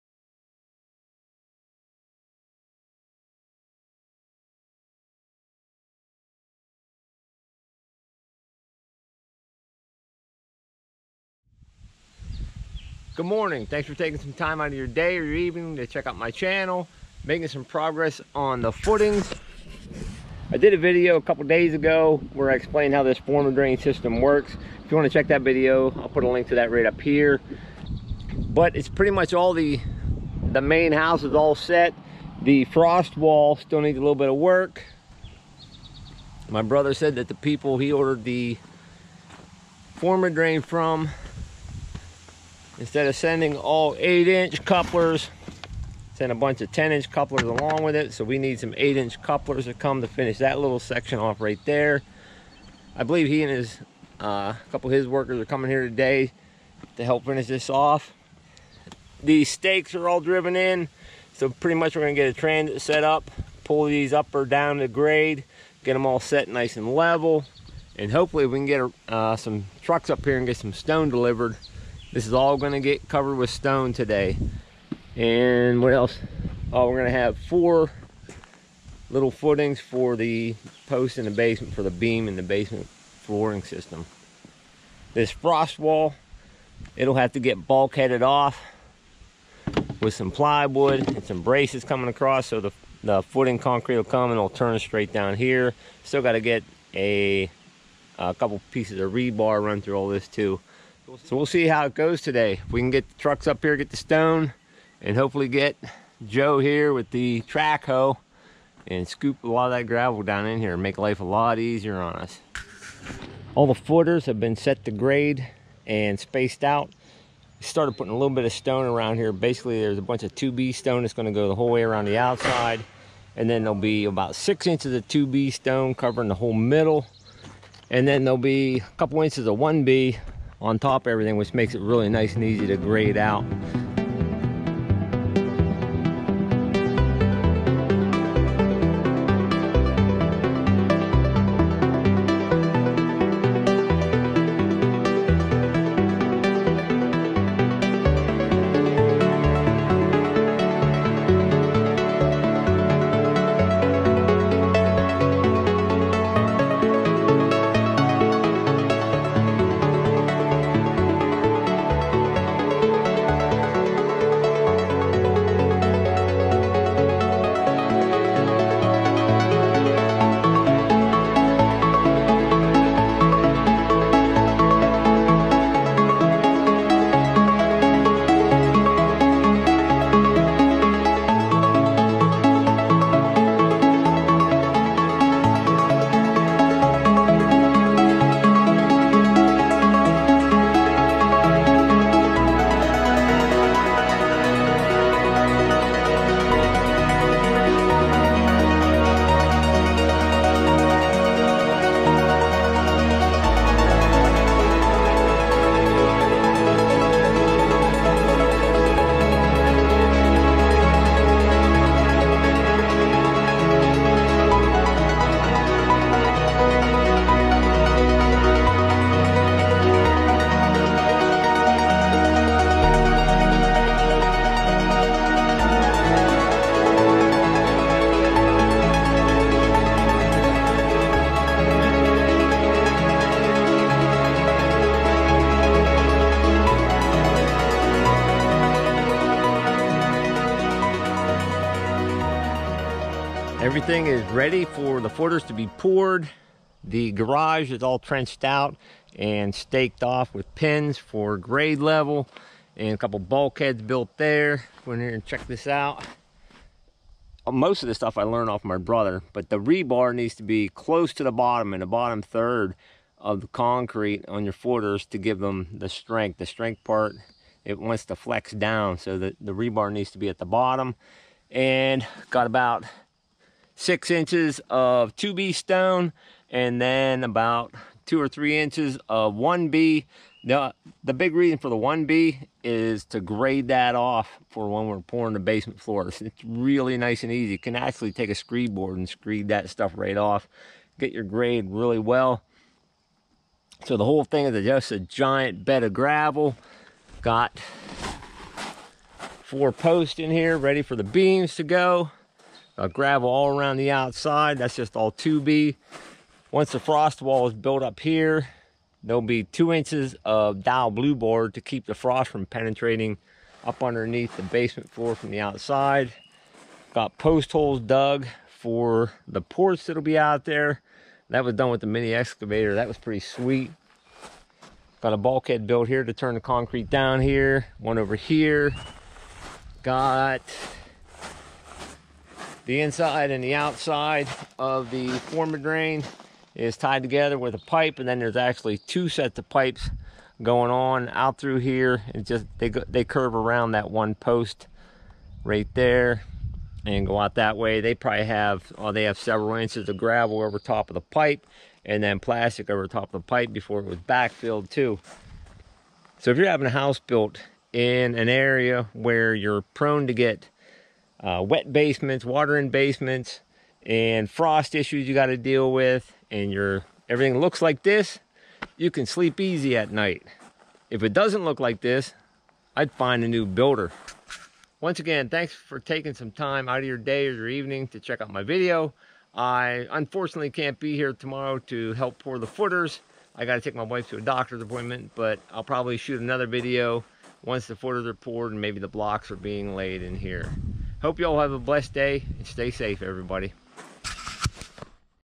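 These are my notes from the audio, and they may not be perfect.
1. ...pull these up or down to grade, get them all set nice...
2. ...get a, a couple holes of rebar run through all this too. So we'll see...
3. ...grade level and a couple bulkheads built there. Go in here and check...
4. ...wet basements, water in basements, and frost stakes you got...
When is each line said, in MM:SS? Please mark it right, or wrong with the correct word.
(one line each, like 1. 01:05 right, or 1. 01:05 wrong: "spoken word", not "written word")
1. 01:03 right
2. 01:36 wrong: "pieces", not "holes"
3. 04:11 right
4. 06:01 wrong: "issues", not "stakes".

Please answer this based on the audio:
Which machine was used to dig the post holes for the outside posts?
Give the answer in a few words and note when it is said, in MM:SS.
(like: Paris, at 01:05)
mini excavator, at 05:21.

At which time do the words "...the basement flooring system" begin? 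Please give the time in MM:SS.
01:22.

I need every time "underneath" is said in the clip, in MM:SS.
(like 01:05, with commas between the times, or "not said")
05:13.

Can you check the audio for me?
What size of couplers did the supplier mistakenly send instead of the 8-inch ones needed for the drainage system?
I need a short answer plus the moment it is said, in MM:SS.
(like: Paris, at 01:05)
10-inch, at 00:46.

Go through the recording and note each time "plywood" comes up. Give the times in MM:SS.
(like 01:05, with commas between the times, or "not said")
01:30.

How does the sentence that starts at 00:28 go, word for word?
But it's pretty much all the, the main house is all set.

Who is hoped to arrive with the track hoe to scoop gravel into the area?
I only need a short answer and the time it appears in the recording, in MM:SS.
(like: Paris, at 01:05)
Joe, at 01:46.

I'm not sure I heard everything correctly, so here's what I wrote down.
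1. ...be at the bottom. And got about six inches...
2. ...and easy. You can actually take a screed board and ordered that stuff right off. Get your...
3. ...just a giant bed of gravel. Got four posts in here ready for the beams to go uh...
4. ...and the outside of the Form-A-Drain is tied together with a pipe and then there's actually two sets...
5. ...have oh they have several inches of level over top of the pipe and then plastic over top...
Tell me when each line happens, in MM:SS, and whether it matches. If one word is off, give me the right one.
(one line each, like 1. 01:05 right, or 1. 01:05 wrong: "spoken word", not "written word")
1. 04:30 right
2. 04:47 wrong: "screed", not "ordered"
3. 04:54 right
4. 05:33 right
5. 05:48 wrong: "gravel", not "level".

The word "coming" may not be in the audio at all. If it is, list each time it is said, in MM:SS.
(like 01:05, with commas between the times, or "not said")
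00:55, 01:31.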